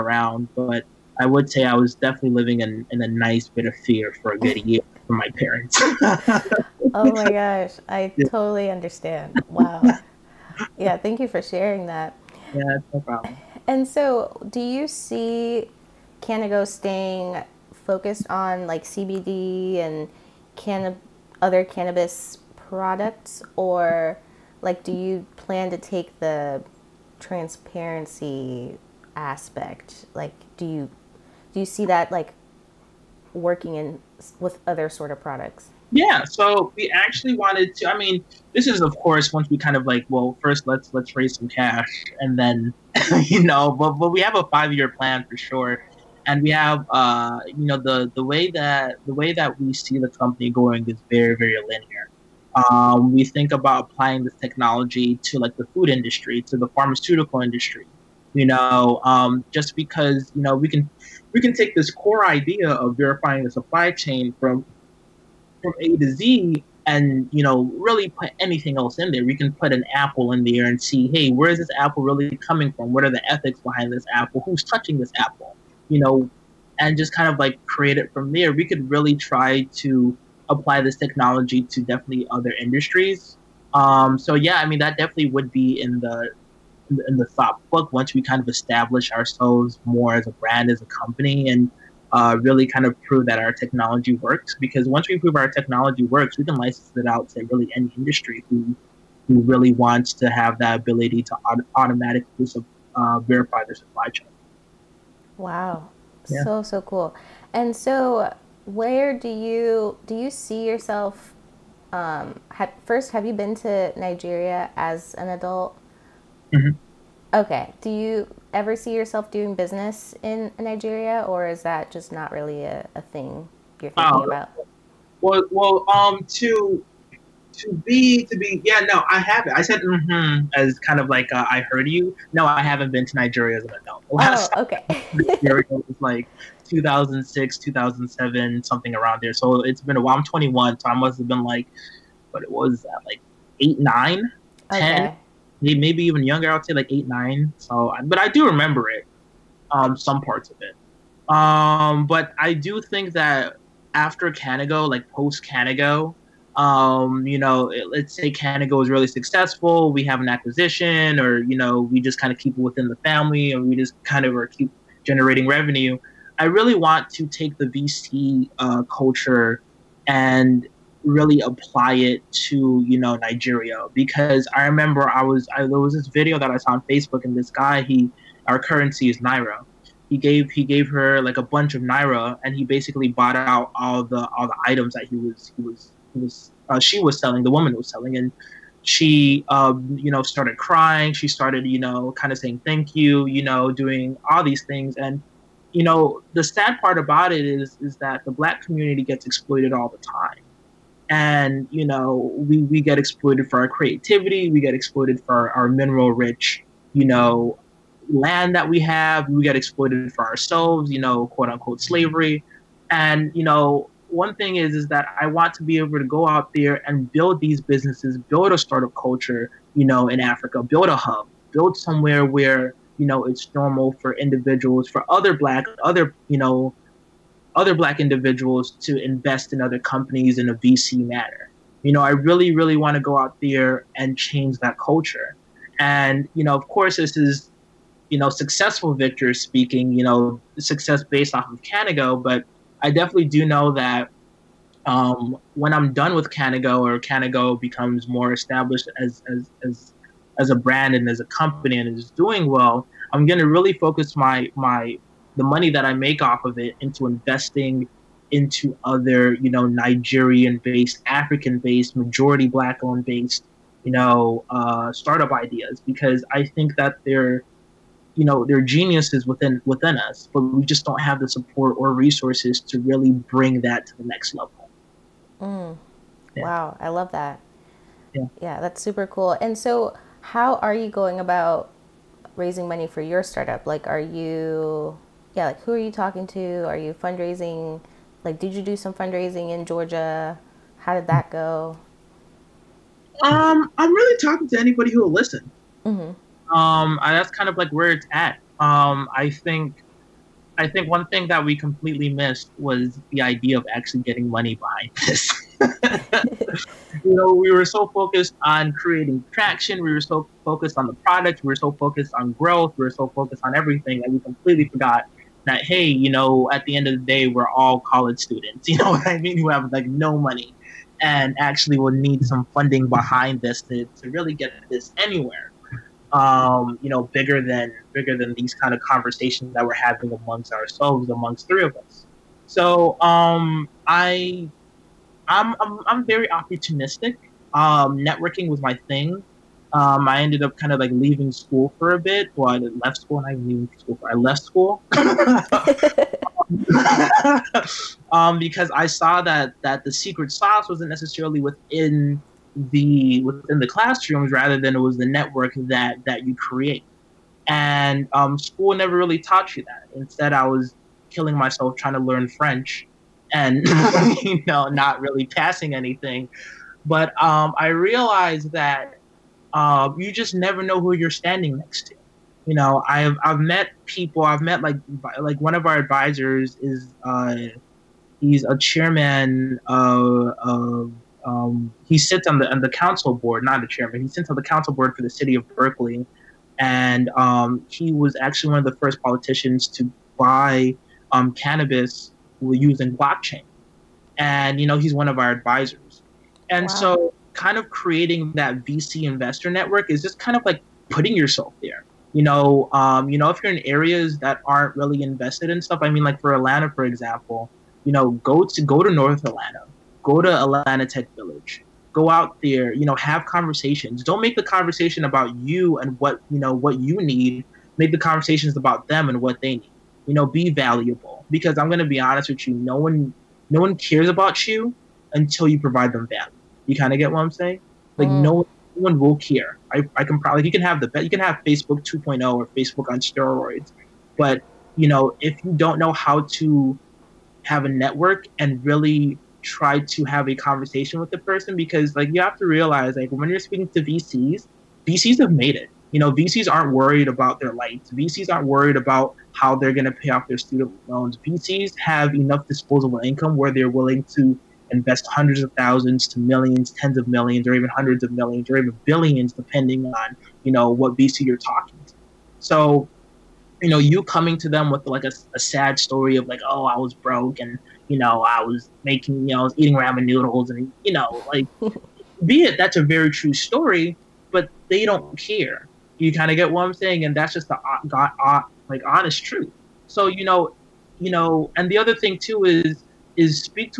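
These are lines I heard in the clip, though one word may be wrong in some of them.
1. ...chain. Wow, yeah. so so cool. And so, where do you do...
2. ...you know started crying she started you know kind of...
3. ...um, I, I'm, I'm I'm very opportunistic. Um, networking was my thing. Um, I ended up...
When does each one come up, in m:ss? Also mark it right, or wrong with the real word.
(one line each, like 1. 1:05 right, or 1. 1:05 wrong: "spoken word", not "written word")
1. 1:44 right
2. 3:10 right
3. 5:32 right.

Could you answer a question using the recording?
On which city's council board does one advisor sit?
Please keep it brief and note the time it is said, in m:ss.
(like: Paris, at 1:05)
Berkeley, at 6:25.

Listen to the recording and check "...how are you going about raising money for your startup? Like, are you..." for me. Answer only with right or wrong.
right.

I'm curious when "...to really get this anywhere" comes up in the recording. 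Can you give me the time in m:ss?
5:24.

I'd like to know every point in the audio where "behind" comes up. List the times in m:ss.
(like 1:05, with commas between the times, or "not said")
1:13, 5:04, 5:22.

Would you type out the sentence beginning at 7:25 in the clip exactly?
You know, VCs aren't worried about their lights.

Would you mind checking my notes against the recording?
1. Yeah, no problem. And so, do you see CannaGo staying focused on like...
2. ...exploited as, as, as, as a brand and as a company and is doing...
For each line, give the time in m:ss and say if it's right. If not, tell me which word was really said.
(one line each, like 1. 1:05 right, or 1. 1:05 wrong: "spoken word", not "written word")
1. 0:12 right
2. 4:08 wrong: "established", not "exploited".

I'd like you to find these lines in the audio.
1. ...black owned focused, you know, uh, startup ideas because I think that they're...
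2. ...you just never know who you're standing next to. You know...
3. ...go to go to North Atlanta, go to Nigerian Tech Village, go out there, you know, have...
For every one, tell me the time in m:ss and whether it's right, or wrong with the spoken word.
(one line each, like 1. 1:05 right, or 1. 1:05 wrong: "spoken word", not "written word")
1. 4:22 wrong: "based", not "focused"
2. 6:09 right
3. 6:48 wrong: "Atlanta", not "Nigerian".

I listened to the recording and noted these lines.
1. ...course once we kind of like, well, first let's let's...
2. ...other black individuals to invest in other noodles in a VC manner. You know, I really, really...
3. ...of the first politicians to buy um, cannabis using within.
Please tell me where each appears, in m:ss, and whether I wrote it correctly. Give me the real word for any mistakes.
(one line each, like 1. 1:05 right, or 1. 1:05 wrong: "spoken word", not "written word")
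1. 0:38 right
2. 3:47 wrong: "companies", not "noodles"
3. 6:28 wrong: "blockchain", not "within".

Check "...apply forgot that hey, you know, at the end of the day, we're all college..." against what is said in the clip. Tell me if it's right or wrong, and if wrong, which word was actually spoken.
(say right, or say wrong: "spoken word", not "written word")
wrong: "completely", not "apply".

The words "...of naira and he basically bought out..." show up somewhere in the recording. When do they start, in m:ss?
3:01.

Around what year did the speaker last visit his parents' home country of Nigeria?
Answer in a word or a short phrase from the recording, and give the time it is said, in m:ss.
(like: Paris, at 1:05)
2006, at 2:16.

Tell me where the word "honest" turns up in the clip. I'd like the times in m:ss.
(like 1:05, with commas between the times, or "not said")
7:01, 7:58.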